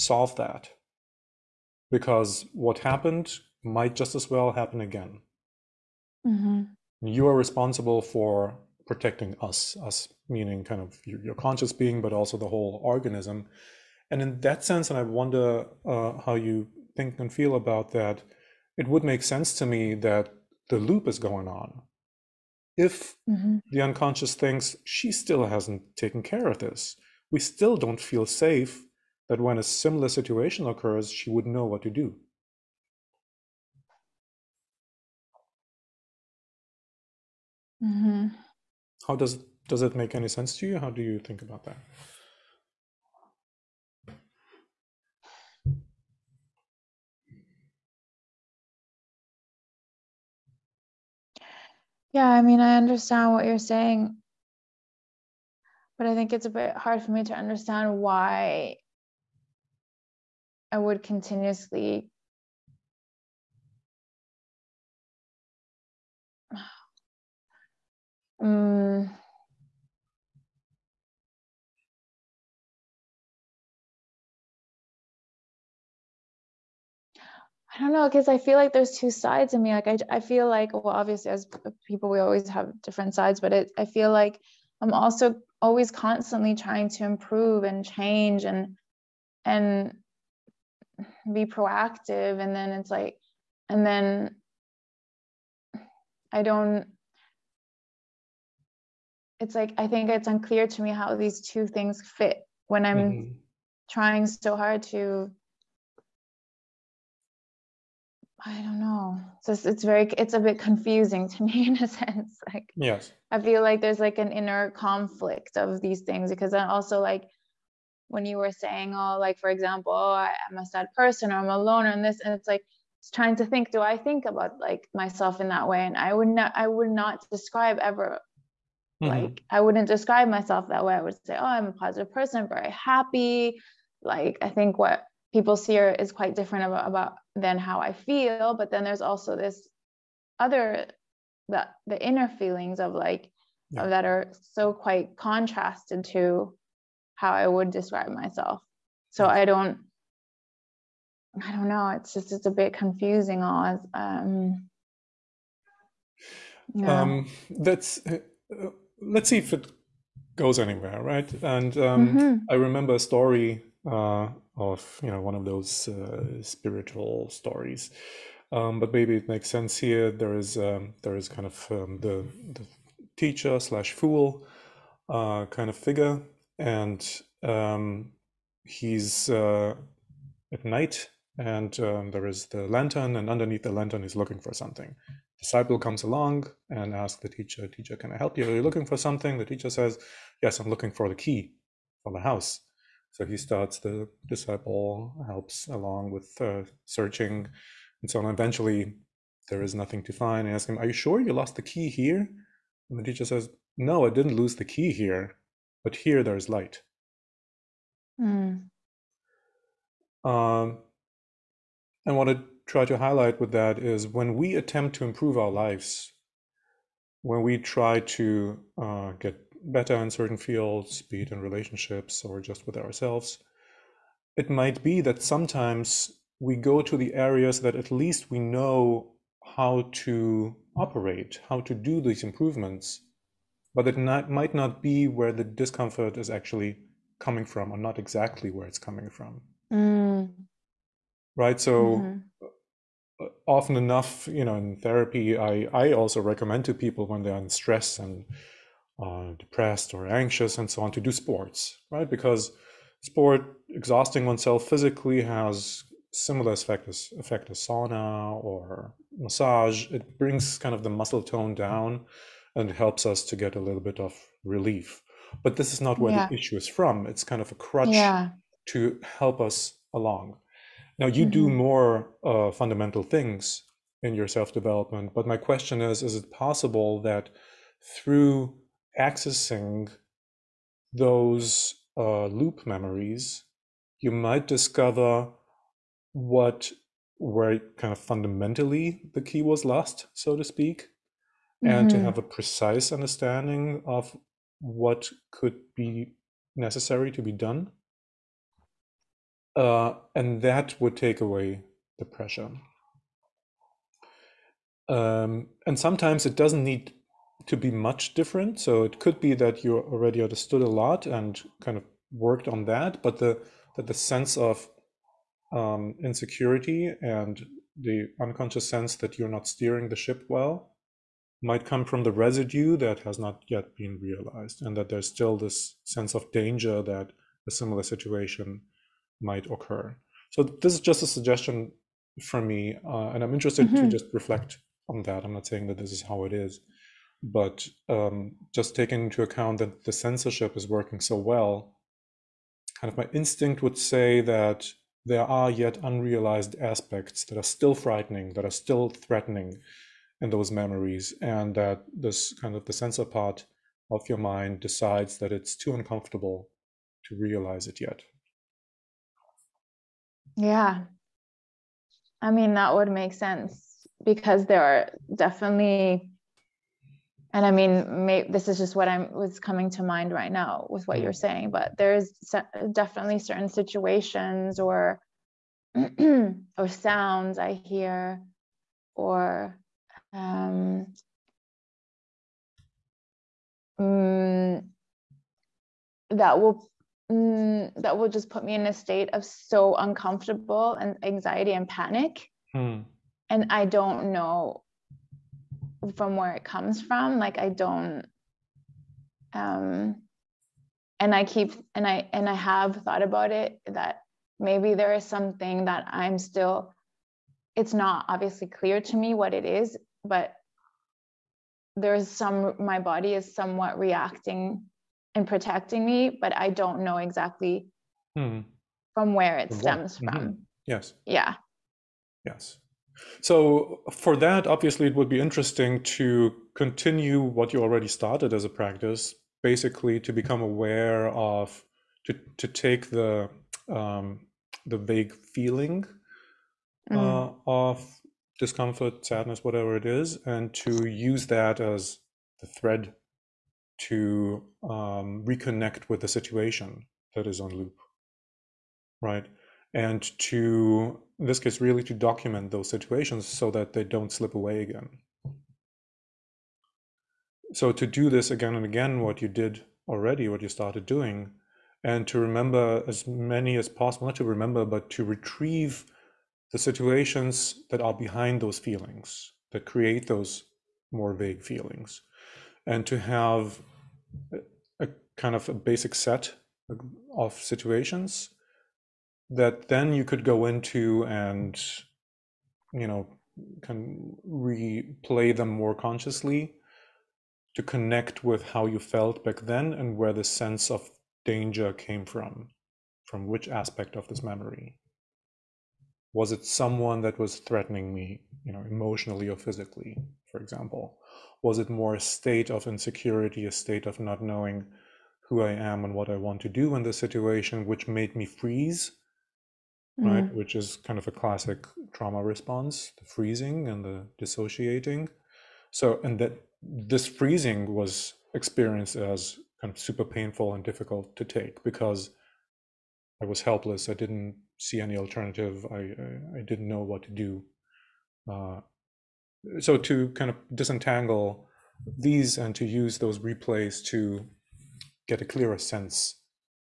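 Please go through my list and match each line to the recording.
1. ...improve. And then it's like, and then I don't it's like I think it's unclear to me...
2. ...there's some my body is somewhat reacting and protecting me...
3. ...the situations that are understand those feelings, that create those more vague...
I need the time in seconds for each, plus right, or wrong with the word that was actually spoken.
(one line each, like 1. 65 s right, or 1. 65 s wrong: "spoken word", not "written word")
1. 91 s wrong: "proactive", not "improve"
2. 411 s right
3. 466 s wrong: "behind", not "understand".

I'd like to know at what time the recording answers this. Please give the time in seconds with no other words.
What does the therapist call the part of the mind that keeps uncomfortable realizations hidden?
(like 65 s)
352 s.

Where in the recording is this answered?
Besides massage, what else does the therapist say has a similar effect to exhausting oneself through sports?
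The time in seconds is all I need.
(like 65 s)
257 s.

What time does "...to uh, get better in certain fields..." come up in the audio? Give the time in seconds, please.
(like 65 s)
218 s.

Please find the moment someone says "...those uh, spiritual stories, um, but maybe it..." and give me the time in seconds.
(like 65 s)
165 s.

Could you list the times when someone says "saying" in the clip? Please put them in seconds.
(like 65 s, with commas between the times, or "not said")
53 s, 118 s, 335 s, 371 s.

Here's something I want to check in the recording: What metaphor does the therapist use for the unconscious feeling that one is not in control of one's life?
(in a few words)
Steering the ship.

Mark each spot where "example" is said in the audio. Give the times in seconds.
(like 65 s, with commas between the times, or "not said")
119 s, 500 s.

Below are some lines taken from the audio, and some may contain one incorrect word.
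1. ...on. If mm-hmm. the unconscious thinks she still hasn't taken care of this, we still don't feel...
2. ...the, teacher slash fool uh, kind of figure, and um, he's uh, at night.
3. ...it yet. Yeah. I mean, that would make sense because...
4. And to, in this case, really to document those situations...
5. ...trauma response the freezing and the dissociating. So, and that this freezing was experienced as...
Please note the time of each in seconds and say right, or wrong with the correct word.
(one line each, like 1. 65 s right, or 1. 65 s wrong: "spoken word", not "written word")
1. 21 s right
2. 172 s right
3. 357 s right
4. 449 s right
5. 511 s right.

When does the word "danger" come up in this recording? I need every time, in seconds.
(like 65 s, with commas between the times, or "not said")
326 s, 491 s.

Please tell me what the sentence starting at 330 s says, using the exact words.
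So this is just a suggestion from me, uh, and I'm interested mm-hmm.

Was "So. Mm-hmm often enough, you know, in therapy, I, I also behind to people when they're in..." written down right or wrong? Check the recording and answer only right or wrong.
wrong.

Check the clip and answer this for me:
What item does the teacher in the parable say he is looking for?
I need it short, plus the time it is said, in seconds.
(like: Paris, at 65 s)
The key for the house, at 191 s.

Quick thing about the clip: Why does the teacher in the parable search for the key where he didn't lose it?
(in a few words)
There is light.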